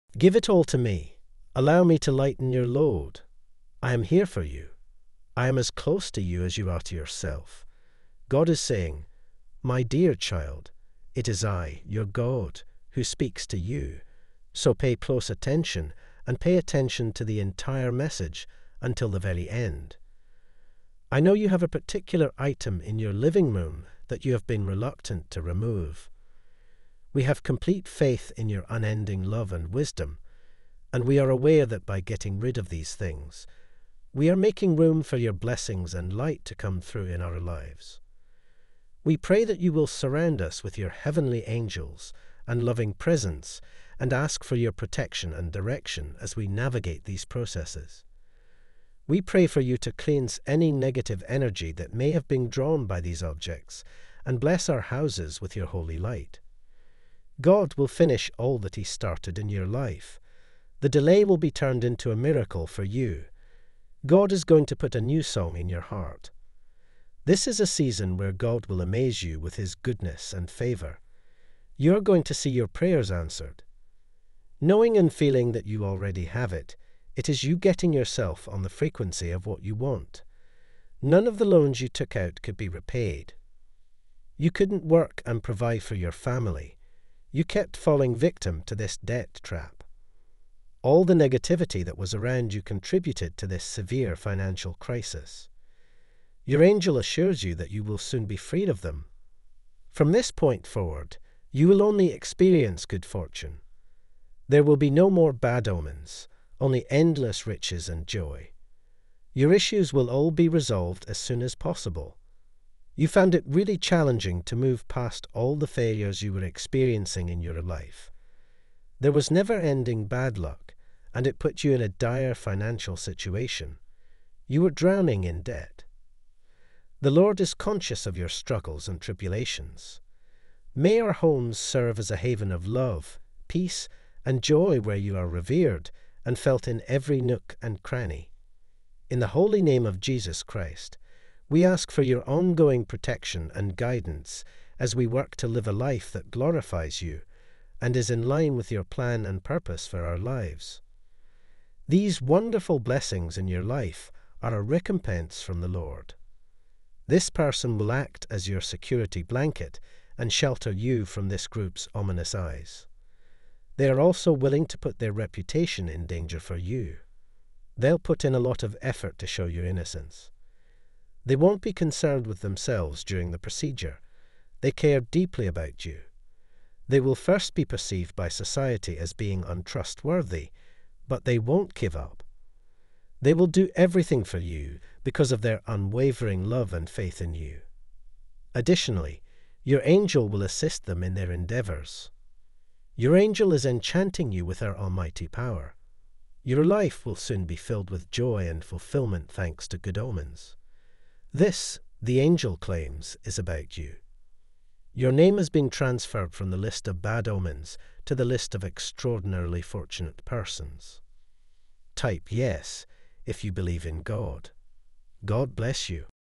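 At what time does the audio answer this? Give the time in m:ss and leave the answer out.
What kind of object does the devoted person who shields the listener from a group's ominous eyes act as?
2:38.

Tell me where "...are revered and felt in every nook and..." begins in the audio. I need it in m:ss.
2:15.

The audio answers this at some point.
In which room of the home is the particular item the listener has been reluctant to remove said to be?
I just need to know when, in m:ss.
0:23.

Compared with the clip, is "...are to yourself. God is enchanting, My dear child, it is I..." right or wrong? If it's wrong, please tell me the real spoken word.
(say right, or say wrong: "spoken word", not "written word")
wrong: "saying", not "enchanting".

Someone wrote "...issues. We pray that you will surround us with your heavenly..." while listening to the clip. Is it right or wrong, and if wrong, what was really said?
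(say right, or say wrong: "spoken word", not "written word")
wrong: "lives", not "issues".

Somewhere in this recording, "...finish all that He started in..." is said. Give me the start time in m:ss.
0:57.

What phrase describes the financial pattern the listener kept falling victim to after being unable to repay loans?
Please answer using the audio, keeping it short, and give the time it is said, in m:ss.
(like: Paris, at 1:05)
debt trap, at 1:28.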